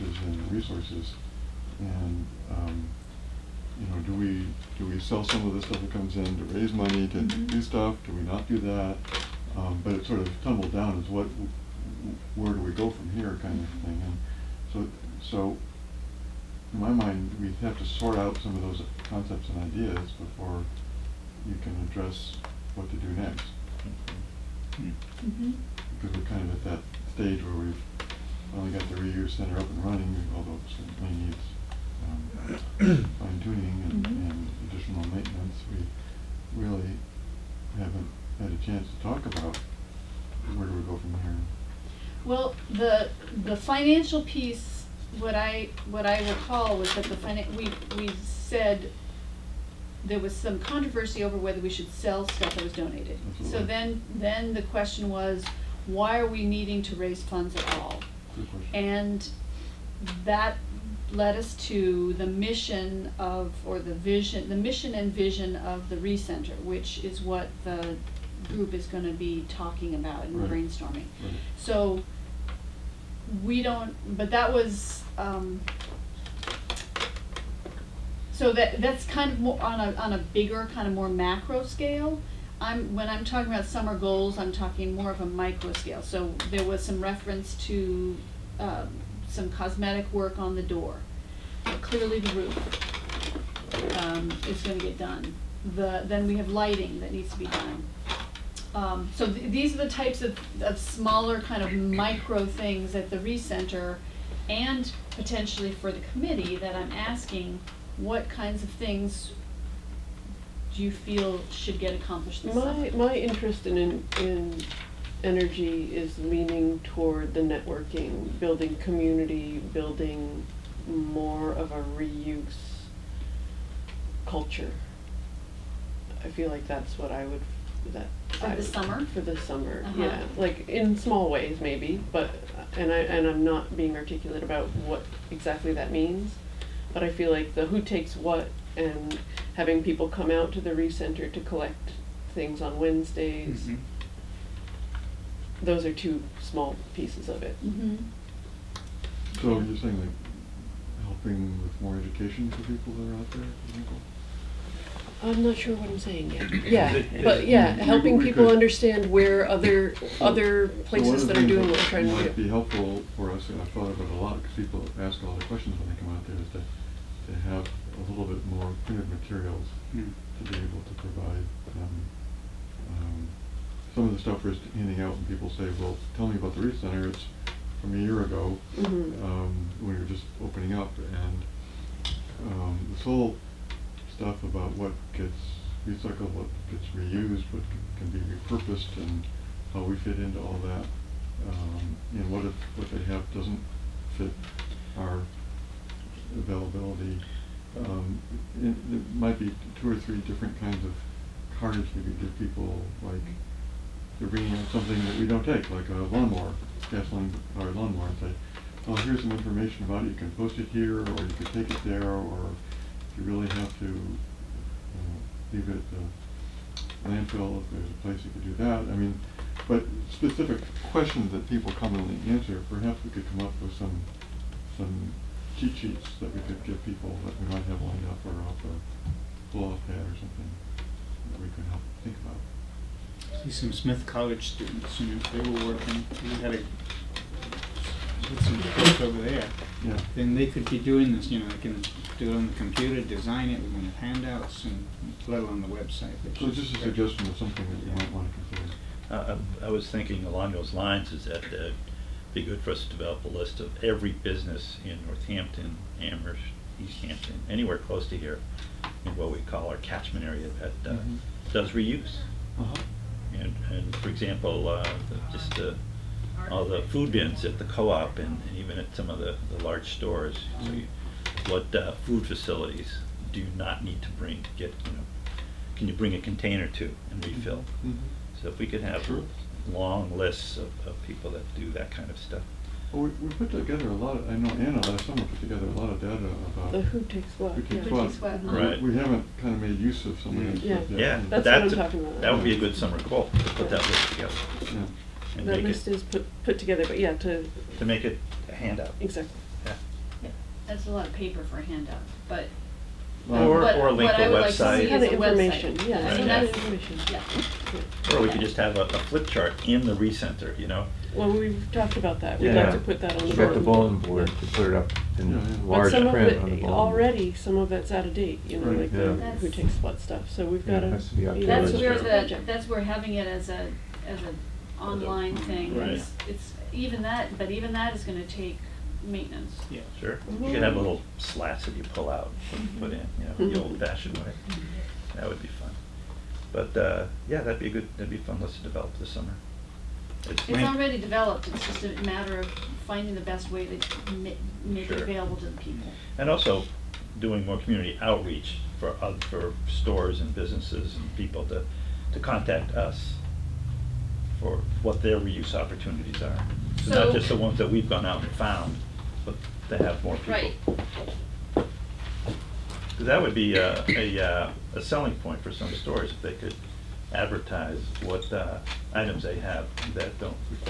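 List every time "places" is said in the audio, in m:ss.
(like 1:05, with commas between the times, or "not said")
2:40, 3:38.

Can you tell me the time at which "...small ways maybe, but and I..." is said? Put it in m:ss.
2:10.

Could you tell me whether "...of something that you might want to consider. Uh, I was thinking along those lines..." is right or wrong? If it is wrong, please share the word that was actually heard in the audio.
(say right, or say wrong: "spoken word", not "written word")
right.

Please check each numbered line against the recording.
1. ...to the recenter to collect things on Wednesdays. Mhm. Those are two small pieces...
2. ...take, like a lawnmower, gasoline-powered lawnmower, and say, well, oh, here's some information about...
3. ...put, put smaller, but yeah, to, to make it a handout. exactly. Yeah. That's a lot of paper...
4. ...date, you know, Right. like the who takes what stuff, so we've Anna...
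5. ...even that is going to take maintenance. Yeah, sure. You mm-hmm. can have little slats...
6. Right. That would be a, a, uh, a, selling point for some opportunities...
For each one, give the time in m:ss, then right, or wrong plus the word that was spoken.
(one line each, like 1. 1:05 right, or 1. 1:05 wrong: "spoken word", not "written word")
1. 2:20 right
2. 3:25 right
3. 4:56 wrong: "together", not "smaller"
4. 5:18 wrong: "Yeah", not "Anna"
5. 5:27 right
6. 6:01 wrong: "stores", not "opportunities".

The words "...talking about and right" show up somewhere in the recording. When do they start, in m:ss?
1:09.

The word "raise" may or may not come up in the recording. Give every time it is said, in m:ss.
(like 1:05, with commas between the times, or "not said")
0:06, 0:56.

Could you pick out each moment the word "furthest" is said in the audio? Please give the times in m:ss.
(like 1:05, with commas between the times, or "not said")
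not said.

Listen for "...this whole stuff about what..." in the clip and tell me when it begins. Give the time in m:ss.
3:02.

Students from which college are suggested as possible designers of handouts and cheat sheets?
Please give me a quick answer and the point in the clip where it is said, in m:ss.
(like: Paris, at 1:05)
Smith College, at 3:53.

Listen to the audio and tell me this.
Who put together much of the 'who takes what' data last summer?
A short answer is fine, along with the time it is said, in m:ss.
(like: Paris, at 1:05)
Anna, at 4:44.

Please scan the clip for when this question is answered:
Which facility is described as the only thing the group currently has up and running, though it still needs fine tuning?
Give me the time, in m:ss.
0:29.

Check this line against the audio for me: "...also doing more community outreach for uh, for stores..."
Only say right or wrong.
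right.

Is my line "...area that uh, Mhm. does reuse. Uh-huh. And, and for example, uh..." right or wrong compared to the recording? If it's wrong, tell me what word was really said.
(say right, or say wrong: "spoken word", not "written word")
right.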